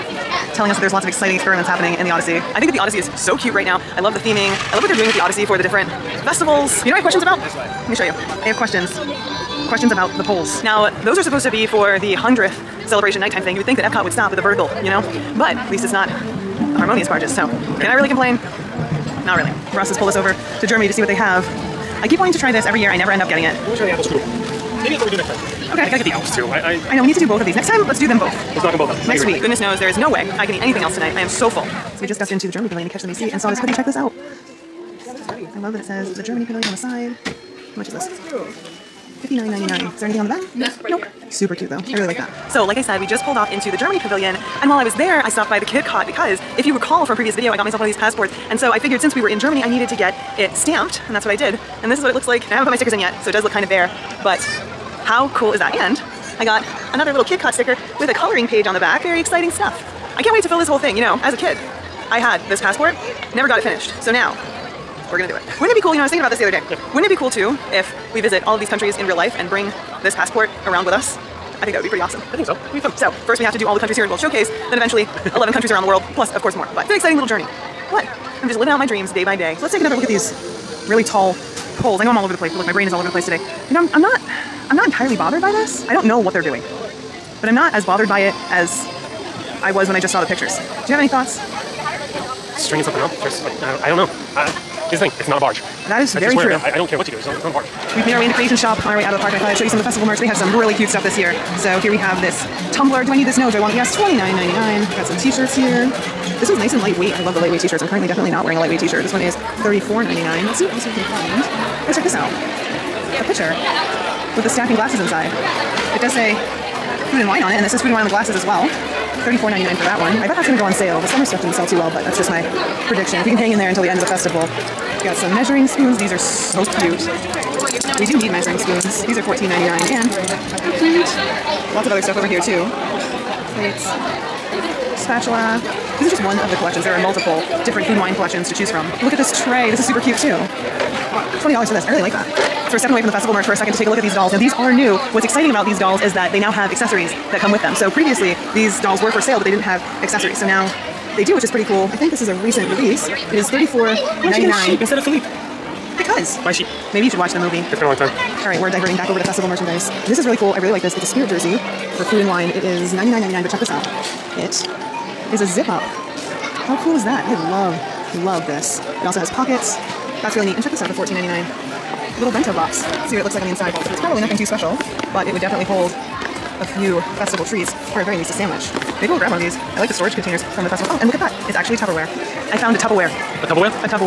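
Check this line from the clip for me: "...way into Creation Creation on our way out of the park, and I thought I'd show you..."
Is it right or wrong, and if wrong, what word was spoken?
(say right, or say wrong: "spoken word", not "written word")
wrong: "Shop", not "Creation".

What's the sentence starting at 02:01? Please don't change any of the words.
The summer stuff didn't sell too well, but that's just my prediction.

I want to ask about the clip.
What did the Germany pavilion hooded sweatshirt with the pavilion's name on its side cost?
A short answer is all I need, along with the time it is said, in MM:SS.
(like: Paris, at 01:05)
$59.99, at 00:38.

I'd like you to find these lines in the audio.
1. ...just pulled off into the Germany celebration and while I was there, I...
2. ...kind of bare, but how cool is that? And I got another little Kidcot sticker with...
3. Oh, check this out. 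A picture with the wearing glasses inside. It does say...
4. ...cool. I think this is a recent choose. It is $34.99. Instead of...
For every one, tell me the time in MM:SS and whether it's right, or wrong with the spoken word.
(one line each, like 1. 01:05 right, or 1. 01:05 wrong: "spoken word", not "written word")
1. 00:43 wrong: "pavilion", not "celebration"
2. 00:53 right
3. 01:51 wrong: "stacking", not "wearing"
4. 02:31 wrong: "release", not "choose".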